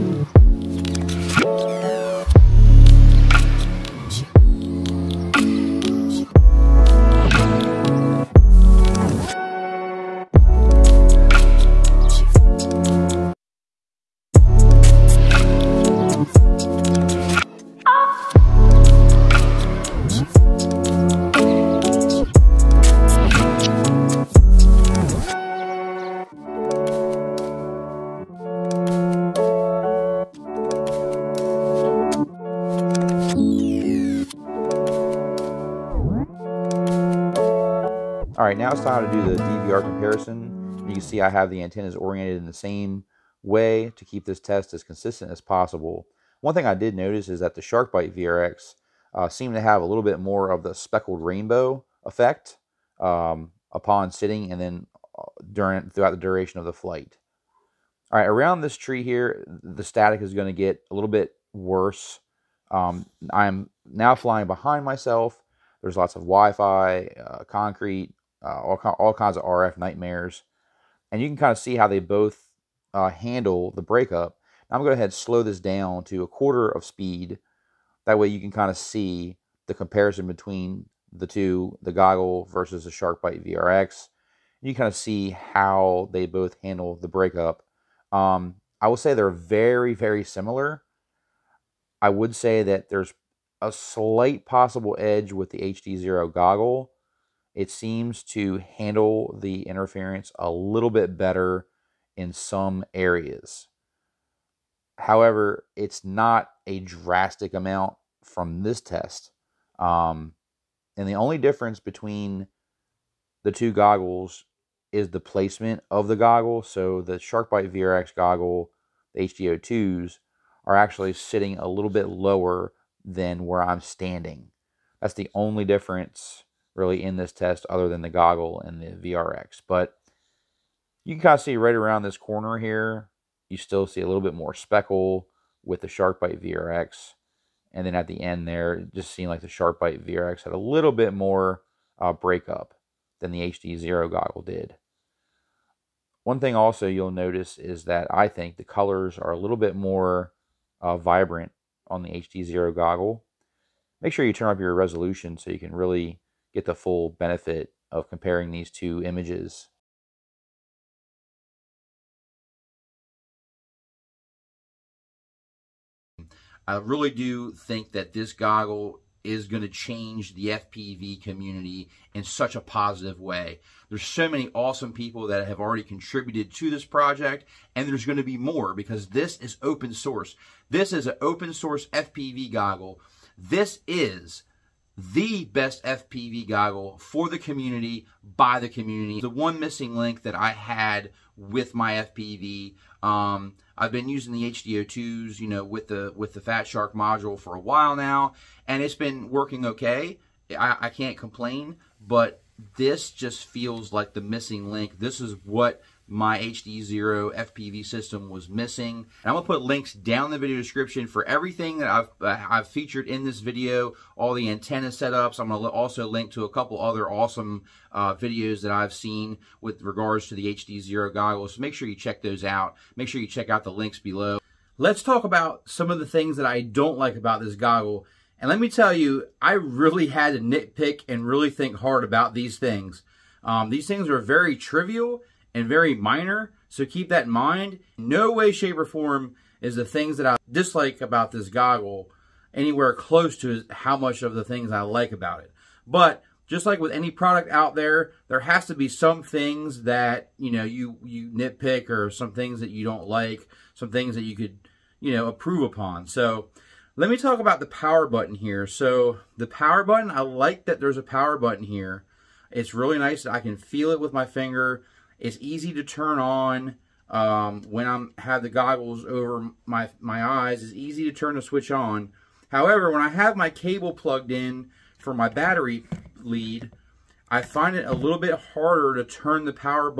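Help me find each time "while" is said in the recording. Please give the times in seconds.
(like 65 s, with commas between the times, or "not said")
197 s.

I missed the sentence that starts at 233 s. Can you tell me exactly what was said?
Um, these things are very trivial and very minor, so keep that in mind.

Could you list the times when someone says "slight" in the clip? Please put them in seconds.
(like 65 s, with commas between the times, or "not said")
93 s.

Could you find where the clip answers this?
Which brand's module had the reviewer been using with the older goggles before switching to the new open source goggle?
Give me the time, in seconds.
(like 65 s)
196 s.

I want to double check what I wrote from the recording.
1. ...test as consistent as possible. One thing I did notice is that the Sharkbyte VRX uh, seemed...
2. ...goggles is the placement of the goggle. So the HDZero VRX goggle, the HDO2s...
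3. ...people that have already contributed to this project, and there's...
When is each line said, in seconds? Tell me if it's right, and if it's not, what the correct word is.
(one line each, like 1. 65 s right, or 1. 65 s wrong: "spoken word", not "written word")
1. 44 s right
2. 113 s wrong: "Sharkbyte", not "HDZero"
3. 174 s right.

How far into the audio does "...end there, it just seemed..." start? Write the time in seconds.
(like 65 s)
138 s.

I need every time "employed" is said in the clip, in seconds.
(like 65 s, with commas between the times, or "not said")
not said.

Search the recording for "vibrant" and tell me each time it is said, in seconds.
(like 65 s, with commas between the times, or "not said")
150 s.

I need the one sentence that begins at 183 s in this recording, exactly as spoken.
This is the best FPV goggle for the community, by the community.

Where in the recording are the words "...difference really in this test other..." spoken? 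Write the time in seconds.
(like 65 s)
125 s.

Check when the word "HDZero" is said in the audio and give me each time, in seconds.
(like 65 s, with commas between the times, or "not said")
95 s, 143 s, 152 s, 206 s, 220 s.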